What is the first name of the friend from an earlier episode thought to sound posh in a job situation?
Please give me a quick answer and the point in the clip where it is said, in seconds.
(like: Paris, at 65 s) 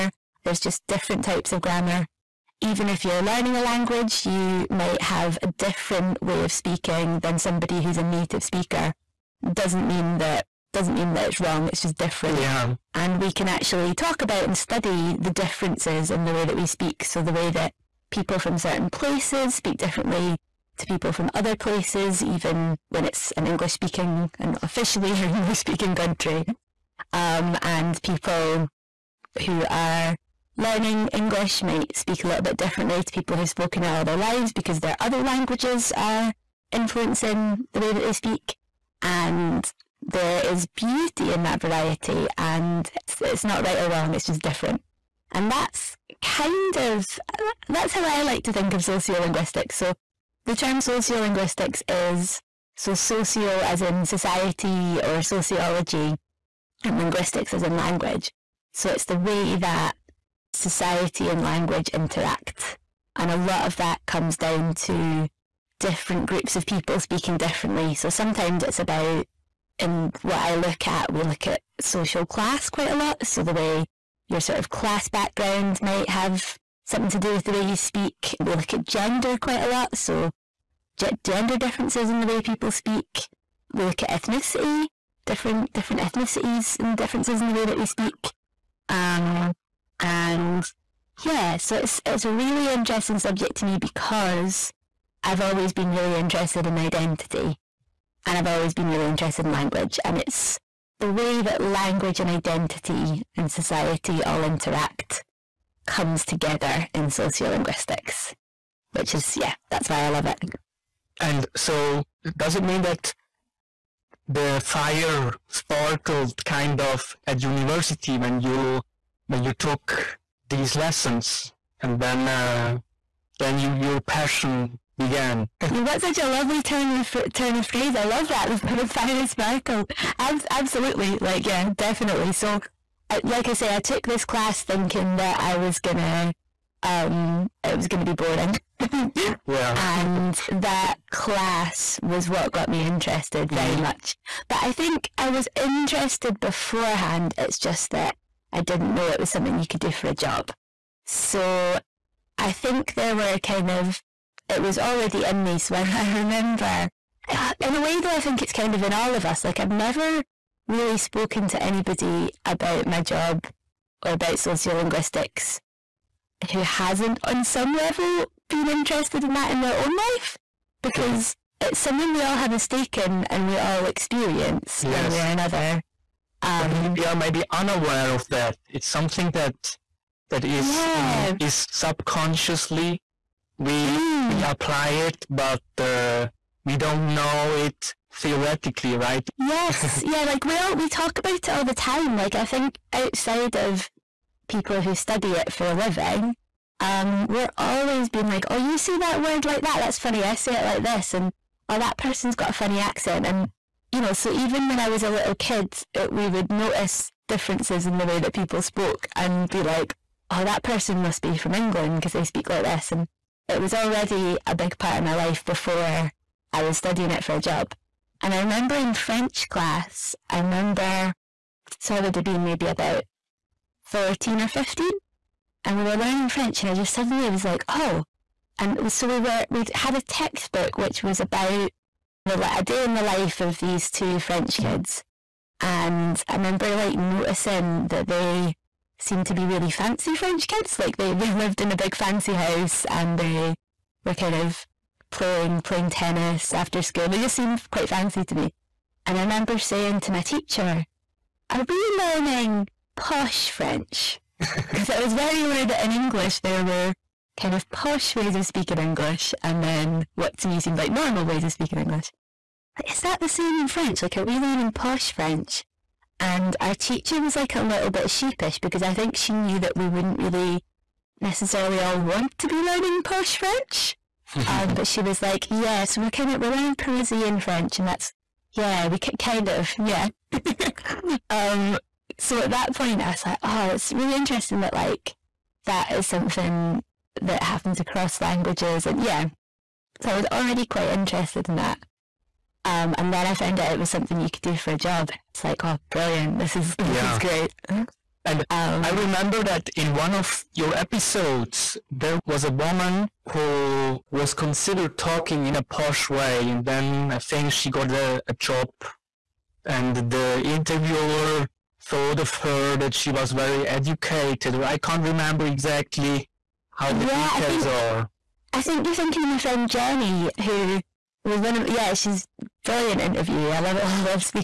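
Jenny, at 319 s.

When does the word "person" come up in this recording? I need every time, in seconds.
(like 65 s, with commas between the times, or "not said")
201 s, 210 s.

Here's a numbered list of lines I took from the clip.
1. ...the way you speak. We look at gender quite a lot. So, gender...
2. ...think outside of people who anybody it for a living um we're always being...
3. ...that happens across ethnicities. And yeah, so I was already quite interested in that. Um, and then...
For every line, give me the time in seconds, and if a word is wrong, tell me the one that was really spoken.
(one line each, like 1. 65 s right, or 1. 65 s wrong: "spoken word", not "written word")
1. 77 s right
2. 192 s wrong: "study", not "anybody"
3. 287 s wrong: "languages", not "ethnicities".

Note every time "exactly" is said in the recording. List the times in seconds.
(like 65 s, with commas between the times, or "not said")
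315 s.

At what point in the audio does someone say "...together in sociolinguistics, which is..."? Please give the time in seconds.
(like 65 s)
106 s.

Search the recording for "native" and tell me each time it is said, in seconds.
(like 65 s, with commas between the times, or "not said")
8 s.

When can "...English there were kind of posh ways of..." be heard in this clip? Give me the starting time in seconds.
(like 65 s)
255 s.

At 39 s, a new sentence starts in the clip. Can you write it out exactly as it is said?
And there is beauty in that variety, and it's, it's not right or wrong, it's just different.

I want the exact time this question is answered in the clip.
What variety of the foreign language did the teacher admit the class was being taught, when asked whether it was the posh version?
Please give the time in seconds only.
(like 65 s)
276 s.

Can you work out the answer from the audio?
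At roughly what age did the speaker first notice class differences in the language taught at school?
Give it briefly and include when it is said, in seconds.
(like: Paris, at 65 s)
14 or 15, at 223 s.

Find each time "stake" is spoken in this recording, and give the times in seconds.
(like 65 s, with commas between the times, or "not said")
172 s.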